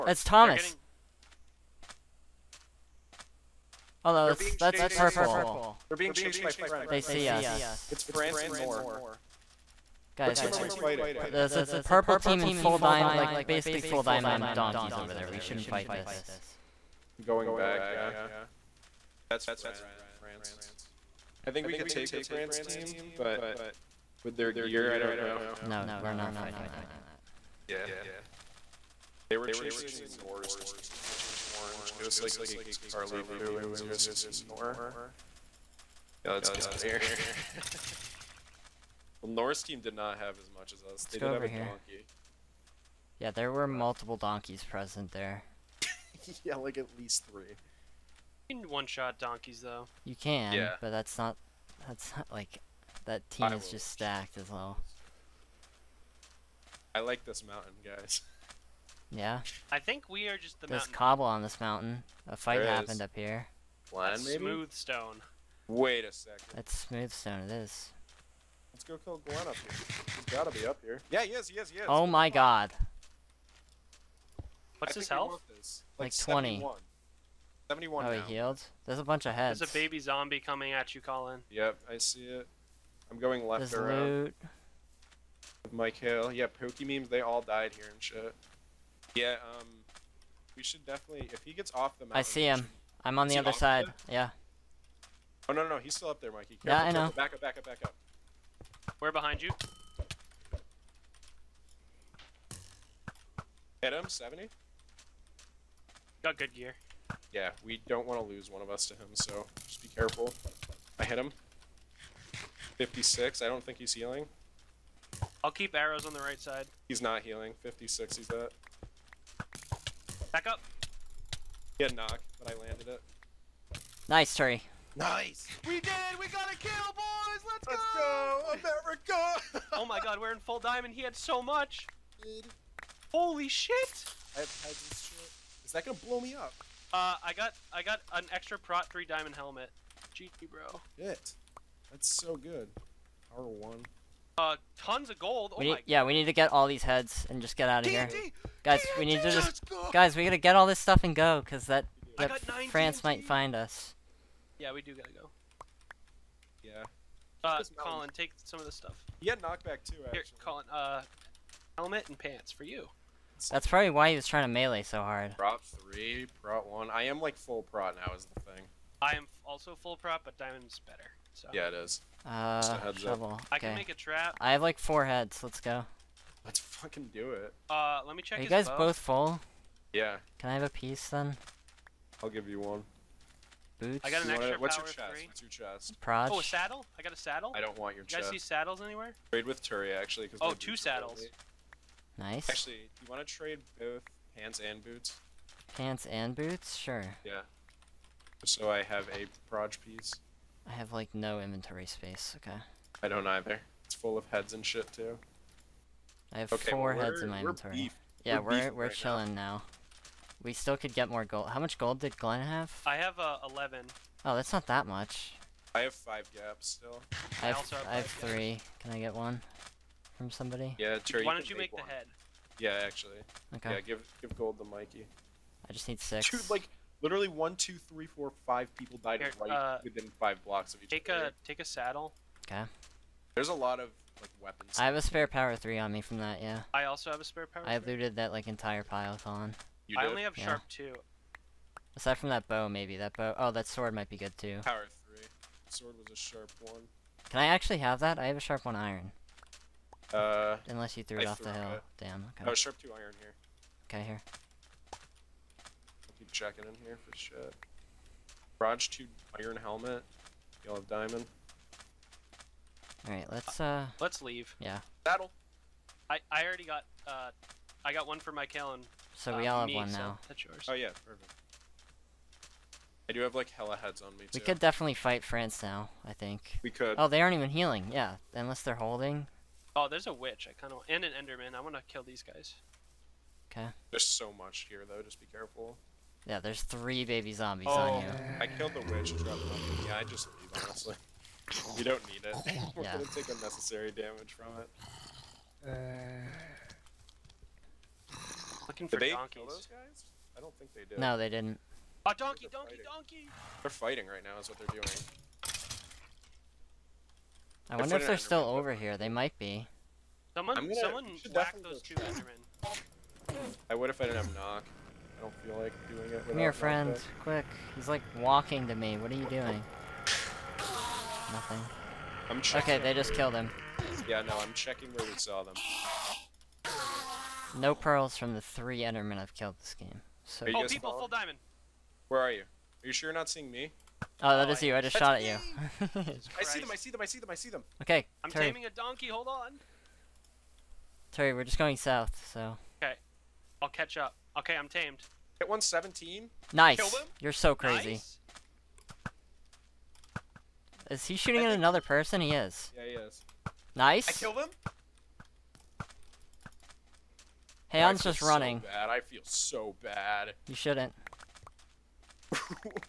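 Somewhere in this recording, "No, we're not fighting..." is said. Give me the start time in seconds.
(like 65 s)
25 s.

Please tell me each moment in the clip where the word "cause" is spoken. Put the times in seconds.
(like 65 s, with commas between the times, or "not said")
151 s, 190 s.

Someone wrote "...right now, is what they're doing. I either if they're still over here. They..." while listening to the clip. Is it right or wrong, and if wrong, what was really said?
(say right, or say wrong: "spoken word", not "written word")
wrong: "wonder", not "either".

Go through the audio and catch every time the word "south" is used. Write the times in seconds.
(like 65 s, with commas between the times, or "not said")
341 s.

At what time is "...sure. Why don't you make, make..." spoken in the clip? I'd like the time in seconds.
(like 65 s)
221 s.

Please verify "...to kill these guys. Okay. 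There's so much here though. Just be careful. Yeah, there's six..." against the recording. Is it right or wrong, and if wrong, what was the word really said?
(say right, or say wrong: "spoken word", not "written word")
wrong: "three", not "six".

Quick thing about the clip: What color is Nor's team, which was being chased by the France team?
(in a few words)
Orange.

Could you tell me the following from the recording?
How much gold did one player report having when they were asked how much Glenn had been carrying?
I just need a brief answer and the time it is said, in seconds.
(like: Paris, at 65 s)
11, at 213 s.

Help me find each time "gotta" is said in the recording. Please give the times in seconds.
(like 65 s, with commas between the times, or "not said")
70 s, 150 s, 154 s.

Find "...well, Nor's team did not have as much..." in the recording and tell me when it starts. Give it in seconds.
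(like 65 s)
39 s.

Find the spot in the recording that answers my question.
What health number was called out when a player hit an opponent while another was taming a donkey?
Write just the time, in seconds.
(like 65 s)
345 s.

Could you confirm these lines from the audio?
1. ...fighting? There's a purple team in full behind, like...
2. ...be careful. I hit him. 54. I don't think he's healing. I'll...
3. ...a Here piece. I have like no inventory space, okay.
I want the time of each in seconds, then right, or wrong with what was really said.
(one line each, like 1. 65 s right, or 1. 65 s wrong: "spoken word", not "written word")
1. 10 s wrong: "diamond", not "behind"
2. 109 s wrong: "56", not "54"
3. 199 s wrong: "Proj", not "Here".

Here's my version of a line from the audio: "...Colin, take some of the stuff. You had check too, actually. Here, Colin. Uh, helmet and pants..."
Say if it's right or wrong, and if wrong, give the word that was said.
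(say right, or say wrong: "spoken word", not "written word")
wrong: "knockback", not "check".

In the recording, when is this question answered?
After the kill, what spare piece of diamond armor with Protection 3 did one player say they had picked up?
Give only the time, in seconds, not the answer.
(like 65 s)
139 s.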